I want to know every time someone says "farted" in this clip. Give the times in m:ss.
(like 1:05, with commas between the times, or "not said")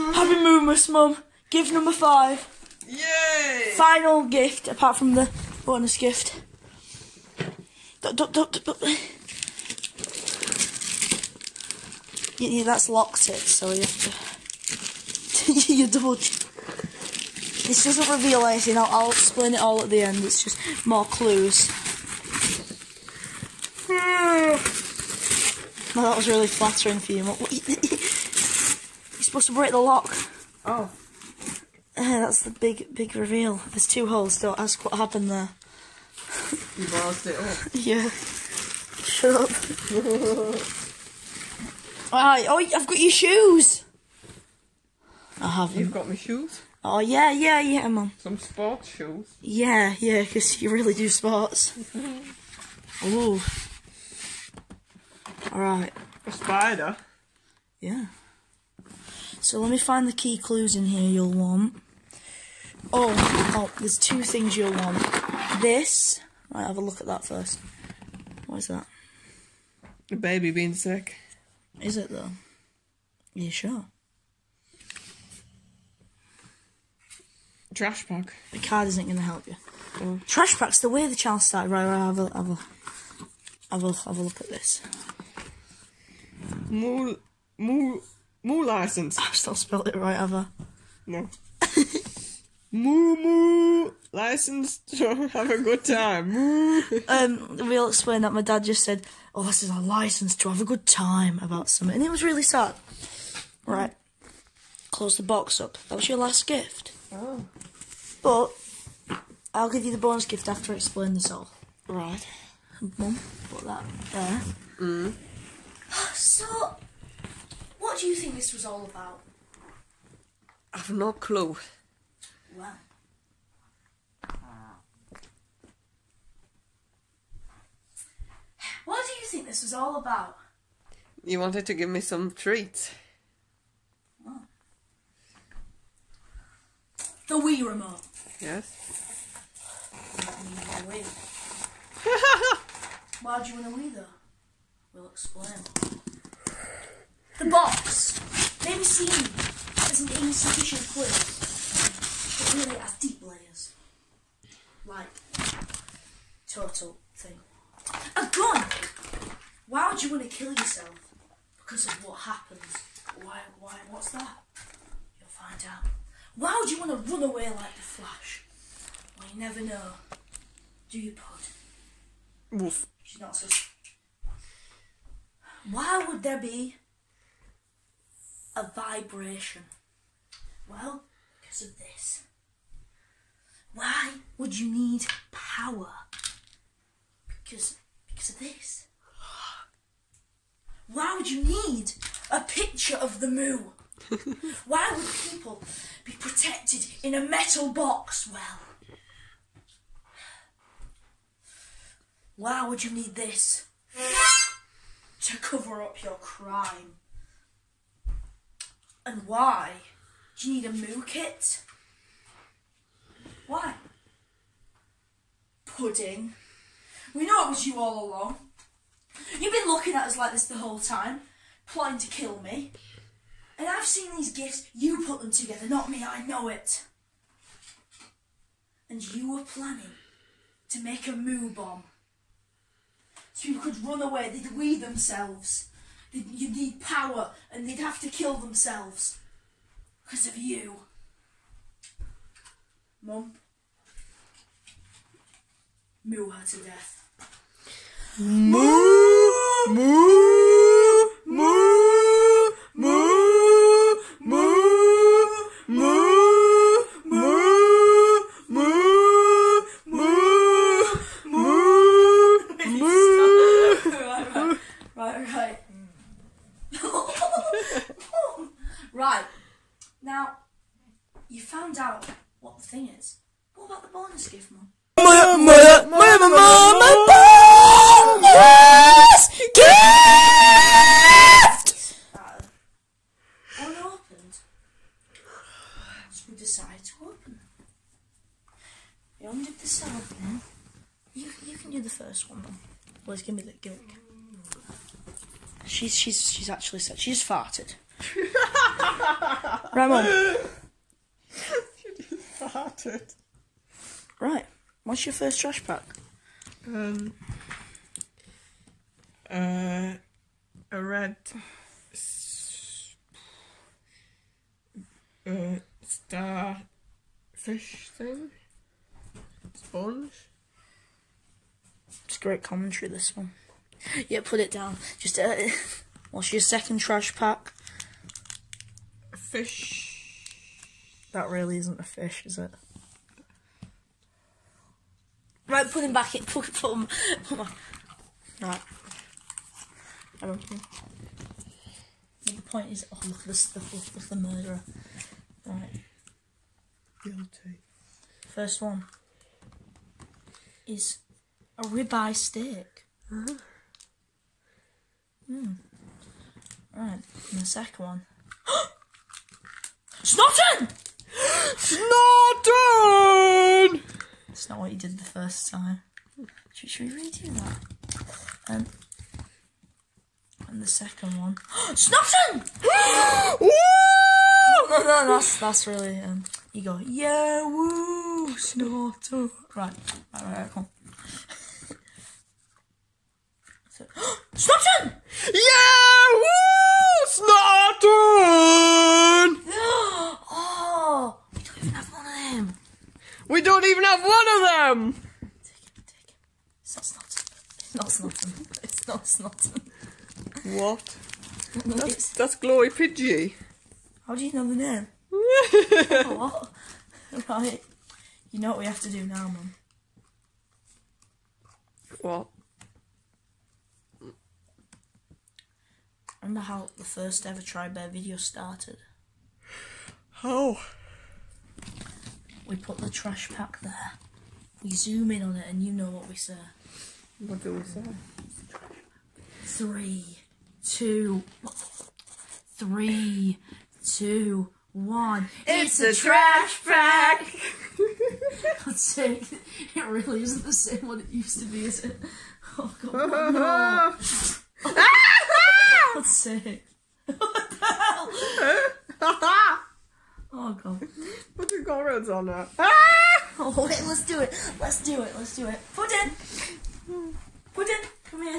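4:57, 5:02.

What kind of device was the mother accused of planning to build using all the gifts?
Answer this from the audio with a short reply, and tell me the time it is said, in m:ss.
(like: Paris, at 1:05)
Moo bomb, at 3:51.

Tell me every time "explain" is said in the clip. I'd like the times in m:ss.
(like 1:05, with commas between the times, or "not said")
0:19, 1:37, 1:50, 2:25.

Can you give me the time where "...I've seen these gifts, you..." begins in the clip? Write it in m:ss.
3:43.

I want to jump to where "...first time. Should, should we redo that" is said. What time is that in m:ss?
6:05.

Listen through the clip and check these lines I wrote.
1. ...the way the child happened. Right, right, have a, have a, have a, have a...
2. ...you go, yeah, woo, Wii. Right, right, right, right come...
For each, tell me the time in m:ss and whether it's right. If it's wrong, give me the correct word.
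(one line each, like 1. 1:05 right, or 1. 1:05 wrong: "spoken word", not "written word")
1. 1:20 wrong: "started", not "happened"
2. 6:16 wrong: "Snotton", not "Wii".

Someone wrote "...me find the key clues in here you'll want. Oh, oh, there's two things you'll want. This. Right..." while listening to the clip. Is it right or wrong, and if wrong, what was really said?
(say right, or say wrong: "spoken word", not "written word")
right.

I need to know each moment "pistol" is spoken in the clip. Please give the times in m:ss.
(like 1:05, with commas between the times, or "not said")
not said.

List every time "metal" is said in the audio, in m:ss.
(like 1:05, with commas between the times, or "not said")
3:17.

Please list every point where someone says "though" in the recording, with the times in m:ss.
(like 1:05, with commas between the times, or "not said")
1:12, 2:23.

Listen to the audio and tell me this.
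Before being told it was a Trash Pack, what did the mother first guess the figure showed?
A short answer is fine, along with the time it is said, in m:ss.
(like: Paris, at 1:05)
A baby being sick, at 1:10.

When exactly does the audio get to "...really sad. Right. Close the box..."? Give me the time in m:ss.
1:42.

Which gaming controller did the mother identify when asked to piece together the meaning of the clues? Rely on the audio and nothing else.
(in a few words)
Wii remote.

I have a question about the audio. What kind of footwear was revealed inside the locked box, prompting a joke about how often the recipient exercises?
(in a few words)
Sports shoes.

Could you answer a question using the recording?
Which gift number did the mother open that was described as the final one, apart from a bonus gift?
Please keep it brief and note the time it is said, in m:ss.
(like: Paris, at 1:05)
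5, at 0:01.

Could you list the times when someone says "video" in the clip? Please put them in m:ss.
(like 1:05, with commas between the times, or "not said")
6:57.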